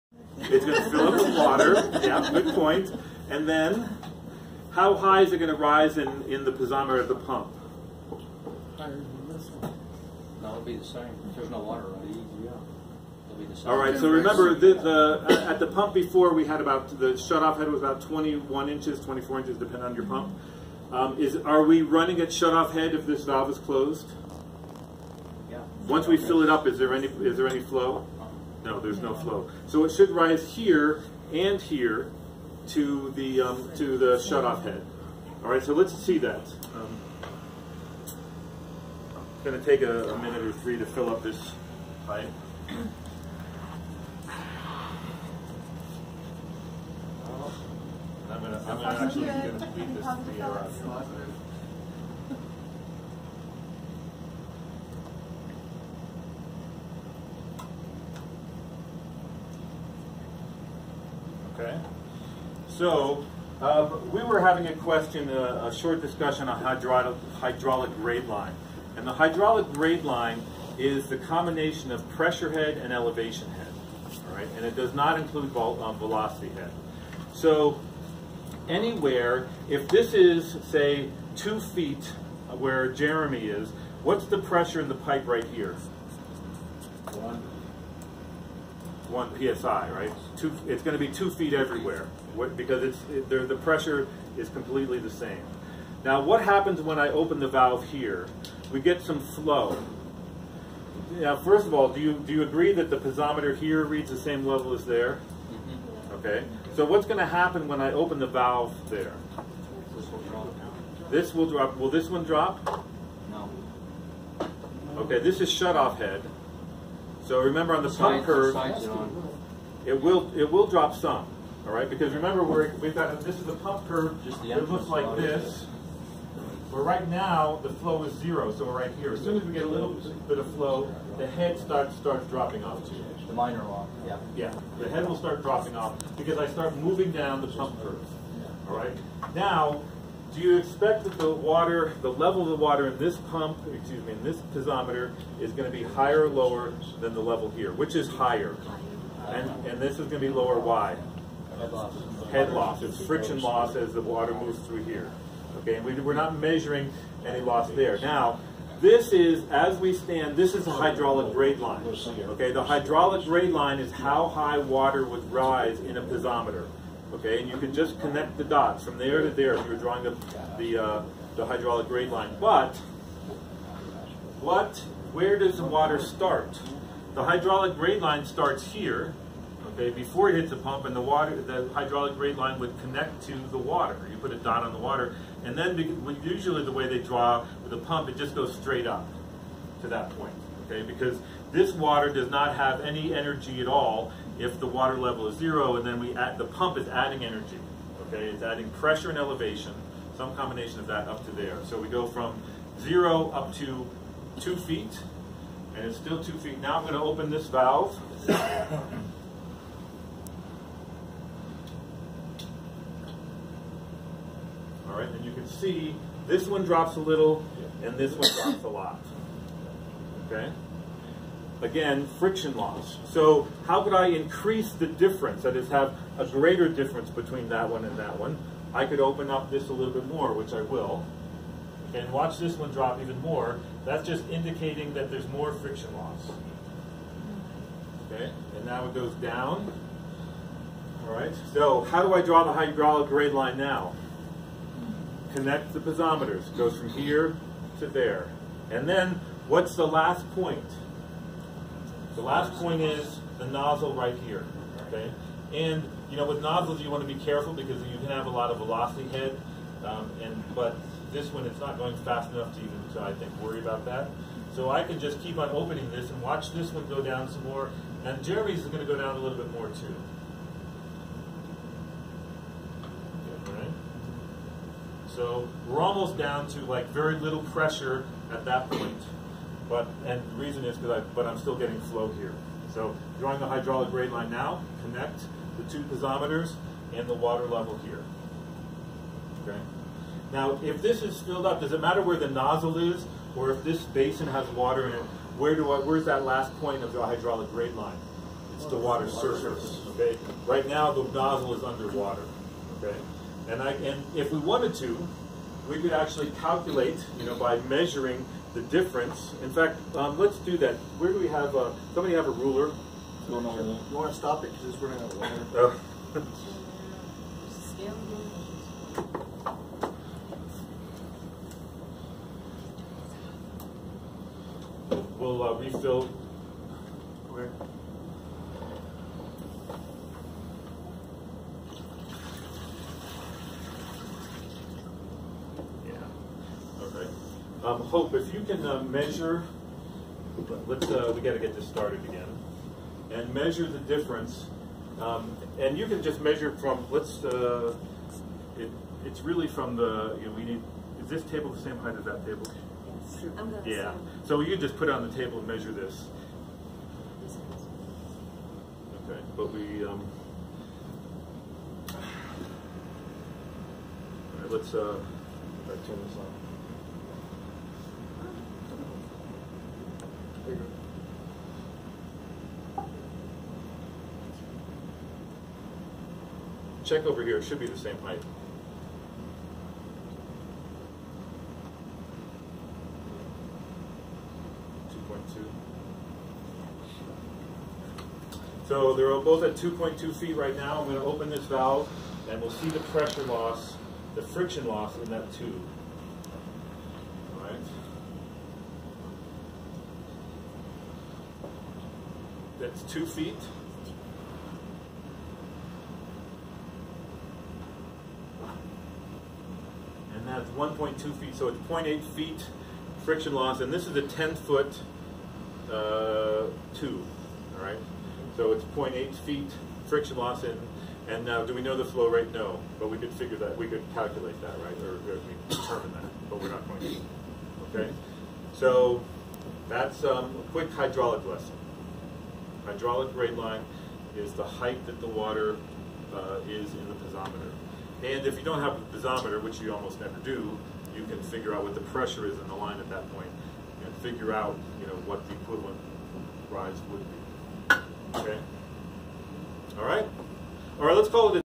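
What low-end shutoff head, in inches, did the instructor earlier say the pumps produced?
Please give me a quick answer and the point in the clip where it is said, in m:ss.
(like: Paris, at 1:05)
21 inches, at 0:18.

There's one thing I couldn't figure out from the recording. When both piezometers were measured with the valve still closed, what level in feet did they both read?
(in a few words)
2.2 feet.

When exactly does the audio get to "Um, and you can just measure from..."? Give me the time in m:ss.
5:45.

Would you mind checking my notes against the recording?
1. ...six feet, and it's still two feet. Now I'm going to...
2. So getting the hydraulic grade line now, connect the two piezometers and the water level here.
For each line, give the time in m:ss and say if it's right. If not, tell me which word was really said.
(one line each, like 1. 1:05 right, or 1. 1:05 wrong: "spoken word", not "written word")
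1. 3:24 wrong: "two", not "six"
2. 4:42 wrong: "drawing", not "getting".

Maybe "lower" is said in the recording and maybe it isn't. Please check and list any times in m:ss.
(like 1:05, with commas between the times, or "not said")
2:26, 2:30.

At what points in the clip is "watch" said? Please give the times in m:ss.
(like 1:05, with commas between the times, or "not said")
3:52, 4:26.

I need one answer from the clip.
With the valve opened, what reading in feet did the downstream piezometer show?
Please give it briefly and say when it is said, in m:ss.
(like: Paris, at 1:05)
1.2 feet, at 6:50.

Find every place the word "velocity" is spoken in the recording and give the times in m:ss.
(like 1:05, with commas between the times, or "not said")
1:15, 4:18.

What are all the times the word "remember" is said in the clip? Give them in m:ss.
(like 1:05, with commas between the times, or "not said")
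0:14, 1:57, 2:02.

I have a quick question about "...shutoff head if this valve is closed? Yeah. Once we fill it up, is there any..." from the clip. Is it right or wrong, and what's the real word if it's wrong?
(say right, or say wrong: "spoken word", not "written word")
right.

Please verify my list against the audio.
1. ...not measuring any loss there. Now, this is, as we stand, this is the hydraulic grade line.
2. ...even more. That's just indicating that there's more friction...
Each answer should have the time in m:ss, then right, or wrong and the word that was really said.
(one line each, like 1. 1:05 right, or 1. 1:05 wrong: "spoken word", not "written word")
1. 2:36 right
2. 3:53 right.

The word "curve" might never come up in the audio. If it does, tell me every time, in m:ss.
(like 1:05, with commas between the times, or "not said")
1:58, 2:03, 2:17.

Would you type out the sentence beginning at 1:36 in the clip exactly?
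Now, what happens when I open the valve here?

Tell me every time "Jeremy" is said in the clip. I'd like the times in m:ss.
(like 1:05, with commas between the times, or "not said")
1:22, 4:28.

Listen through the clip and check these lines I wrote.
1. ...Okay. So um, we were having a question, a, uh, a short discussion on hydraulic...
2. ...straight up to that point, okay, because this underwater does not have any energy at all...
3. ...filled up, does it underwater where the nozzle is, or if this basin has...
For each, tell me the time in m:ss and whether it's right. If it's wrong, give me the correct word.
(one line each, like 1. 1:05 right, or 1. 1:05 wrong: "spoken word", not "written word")
1. 1:01 right
2. 3:08 wrong: "water", not "underwater"
3. 4:51 wrong: "matter", not "underwater".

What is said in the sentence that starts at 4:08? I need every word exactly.
And then what's the last point?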